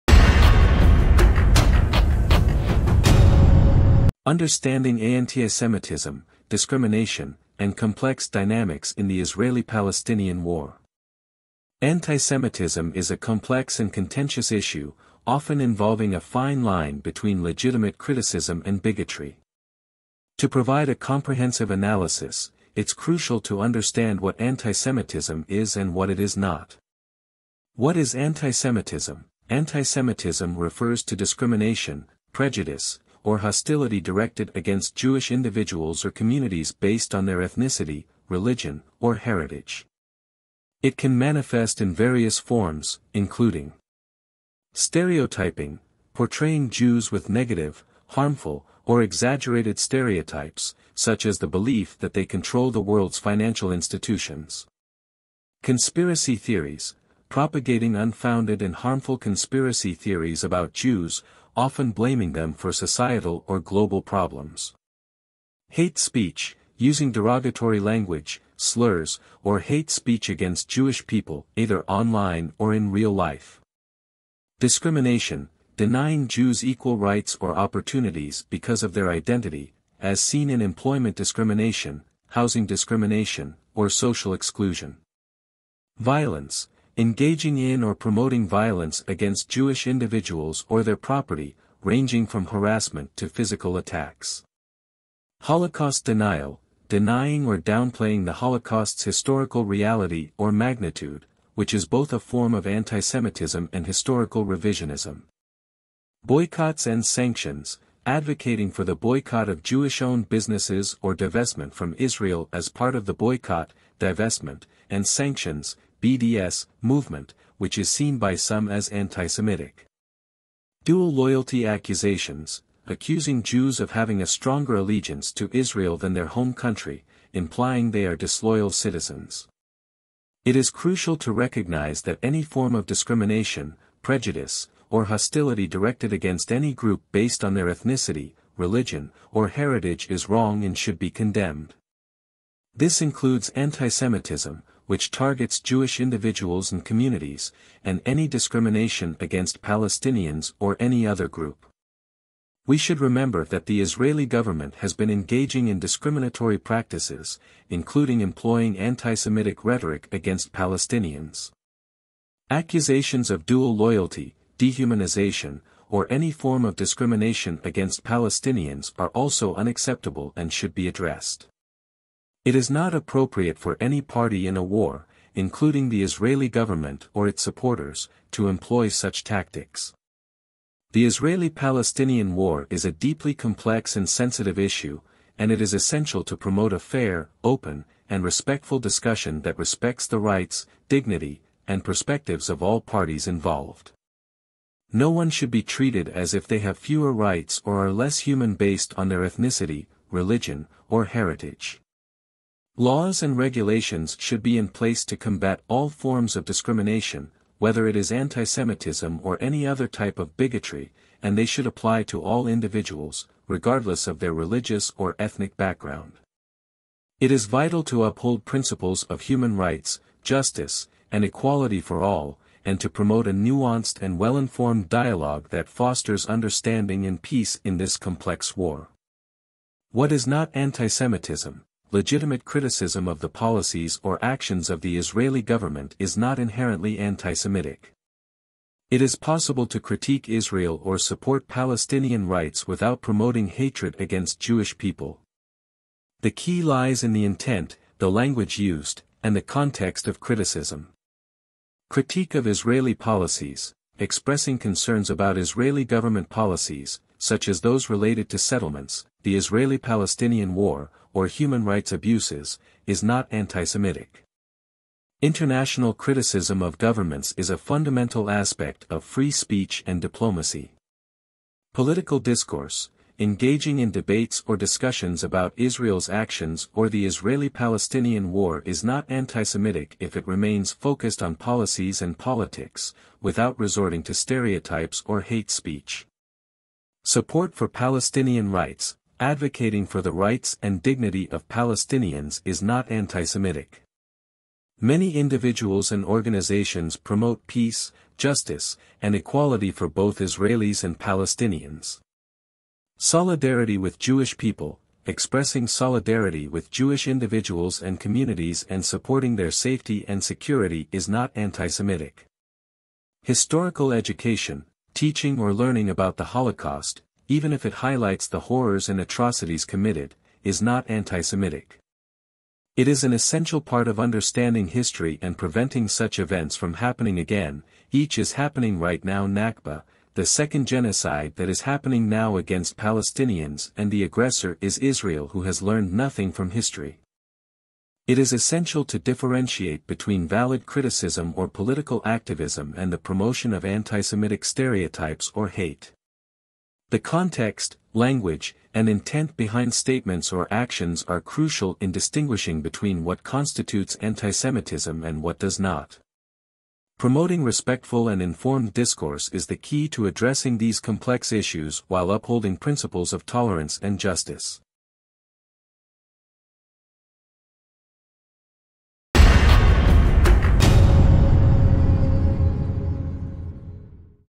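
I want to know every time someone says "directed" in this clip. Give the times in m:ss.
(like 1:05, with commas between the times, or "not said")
0:34, 2:15.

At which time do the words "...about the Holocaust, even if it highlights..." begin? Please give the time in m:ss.
5:15.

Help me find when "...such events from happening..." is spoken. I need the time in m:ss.
5:25.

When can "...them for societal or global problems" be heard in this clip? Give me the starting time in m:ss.
1:02.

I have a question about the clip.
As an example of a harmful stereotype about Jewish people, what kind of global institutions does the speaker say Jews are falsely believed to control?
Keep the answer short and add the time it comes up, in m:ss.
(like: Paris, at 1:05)
Financial institutions, at 0:53.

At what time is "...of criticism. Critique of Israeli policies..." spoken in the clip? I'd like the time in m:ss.
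4:10.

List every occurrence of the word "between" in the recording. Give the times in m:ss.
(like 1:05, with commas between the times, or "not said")
0:16, 5:39, 5:52.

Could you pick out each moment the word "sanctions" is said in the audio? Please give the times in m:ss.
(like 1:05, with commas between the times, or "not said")
1:47, 1:55.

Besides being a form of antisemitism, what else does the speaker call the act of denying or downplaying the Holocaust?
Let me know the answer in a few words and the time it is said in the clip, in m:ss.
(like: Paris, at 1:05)
Historical revisionism, at 1:43.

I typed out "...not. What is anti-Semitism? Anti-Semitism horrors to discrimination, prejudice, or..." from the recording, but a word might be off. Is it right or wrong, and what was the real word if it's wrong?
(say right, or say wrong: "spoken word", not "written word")
wrong: "refers", not "horrors".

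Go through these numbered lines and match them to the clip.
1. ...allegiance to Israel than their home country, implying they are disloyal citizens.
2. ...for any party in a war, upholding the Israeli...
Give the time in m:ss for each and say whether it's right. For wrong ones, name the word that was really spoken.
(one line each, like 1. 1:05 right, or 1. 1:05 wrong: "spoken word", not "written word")
1. 2:04 right
2. 2:53 wrong: "including", not "upholding".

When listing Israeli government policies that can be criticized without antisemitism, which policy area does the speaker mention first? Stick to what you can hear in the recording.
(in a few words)
Settlements.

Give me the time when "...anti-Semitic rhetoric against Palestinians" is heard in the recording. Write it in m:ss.
2:38.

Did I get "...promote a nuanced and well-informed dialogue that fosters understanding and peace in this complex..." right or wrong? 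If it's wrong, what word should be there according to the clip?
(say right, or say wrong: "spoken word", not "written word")
right.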